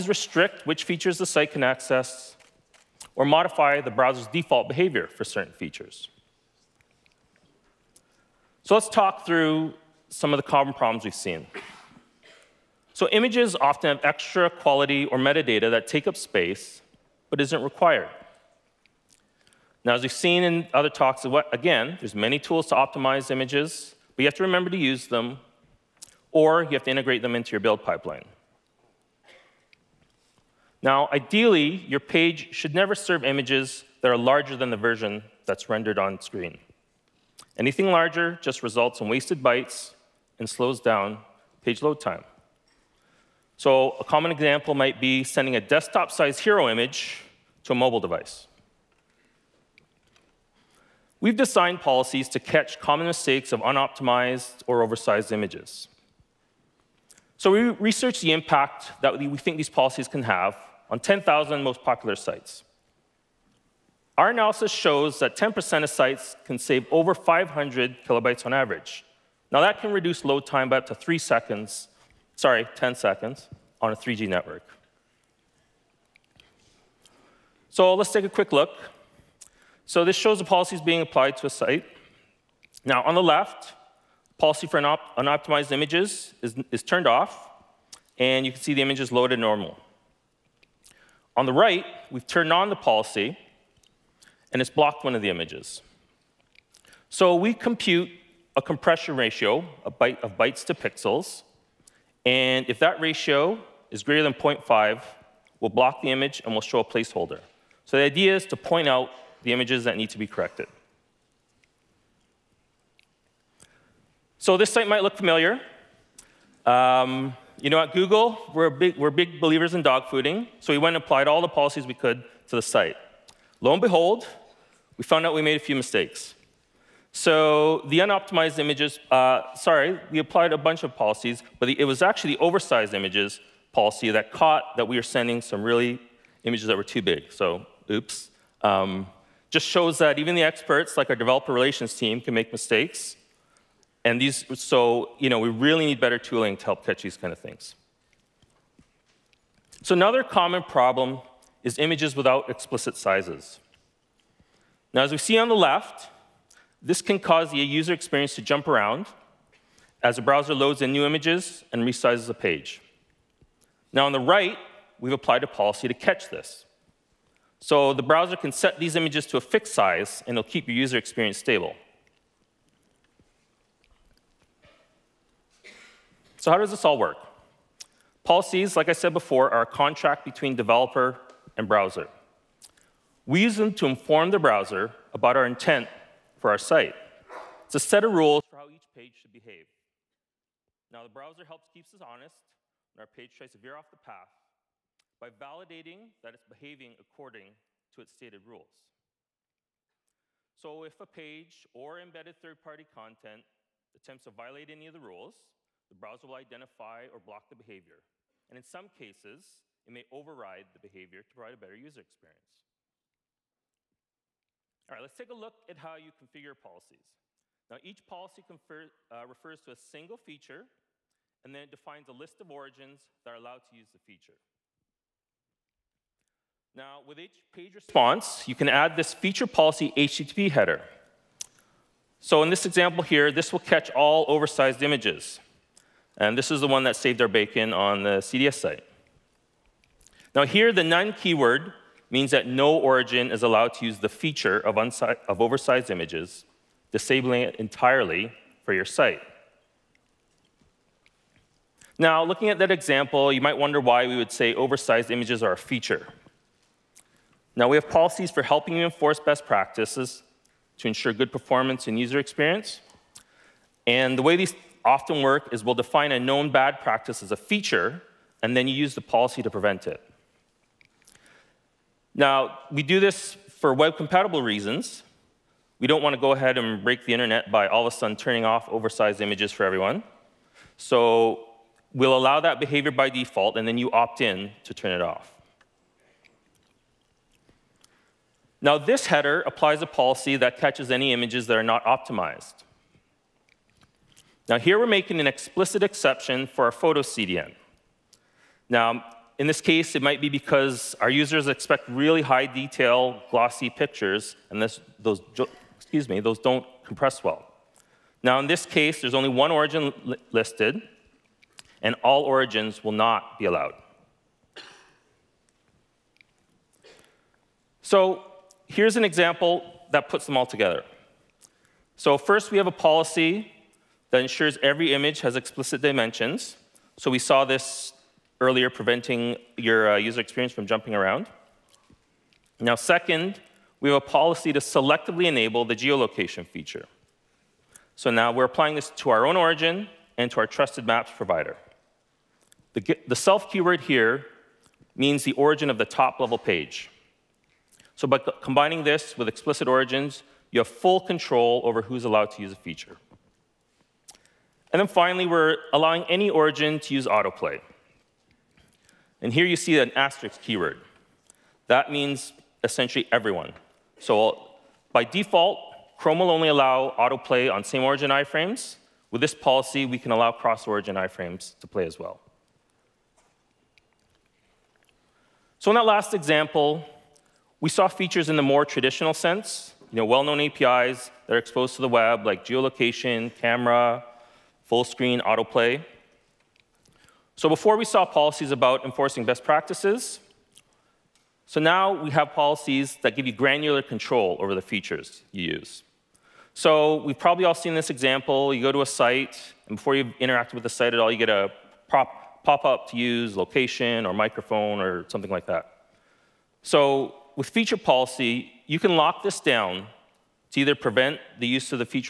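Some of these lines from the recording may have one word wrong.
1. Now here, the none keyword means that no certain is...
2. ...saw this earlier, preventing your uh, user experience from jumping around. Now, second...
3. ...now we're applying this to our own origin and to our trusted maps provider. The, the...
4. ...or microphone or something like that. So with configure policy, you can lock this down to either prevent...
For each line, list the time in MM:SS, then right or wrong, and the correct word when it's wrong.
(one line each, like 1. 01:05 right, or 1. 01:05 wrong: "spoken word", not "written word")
1. 04:00 wrong: "origin", not "certain"
2. 05:27 right
3. 05:38 right
4. 06:44 wrong: "feature", not "configure".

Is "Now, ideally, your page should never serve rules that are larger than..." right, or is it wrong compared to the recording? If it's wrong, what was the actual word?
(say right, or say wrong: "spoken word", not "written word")
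wrong: "images", not "rules".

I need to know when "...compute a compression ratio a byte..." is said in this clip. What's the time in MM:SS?
01:37.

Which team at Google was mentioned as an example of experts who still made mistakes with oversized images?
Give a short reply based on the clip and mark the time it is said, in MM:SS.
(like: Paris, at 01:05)
developer relations, at 02:21.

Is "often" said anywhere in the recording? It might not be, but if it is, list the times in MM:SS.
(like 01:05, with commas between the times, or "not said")
00:13, 04:24.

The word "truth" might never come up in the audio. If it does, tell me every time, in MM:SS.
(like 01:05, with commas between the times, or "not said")
not said.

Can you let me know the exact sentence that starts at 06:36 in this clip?
So we've probably all seen this example.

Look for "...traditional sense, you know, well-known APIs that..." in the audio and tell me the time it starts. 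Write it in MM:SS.
06:18.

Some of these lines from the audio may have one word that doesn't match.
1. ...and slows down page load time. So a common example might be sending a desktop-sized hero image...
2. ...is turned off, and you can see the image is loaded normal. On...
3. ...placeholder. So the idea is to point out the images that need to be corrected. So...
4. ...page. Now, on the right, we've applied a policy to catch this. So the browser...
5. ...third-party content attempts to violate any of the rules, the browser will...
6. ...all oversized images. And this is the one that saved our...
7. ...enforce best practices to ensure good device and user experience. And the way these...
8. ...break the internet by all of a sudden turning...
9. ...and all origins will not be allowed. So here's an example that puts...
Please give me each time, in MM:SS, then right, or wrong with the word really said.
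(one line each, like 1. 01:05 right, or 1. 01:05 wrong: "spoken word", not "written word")
1. 00:40 right
2. 01:26 right
3. 01:46 right
4. 02:42 right
5. 03:22 right
6. 03:53 right
7. 04:18 wrong: "performance", not "device"
8. 04:36 right
9. 05:11 right.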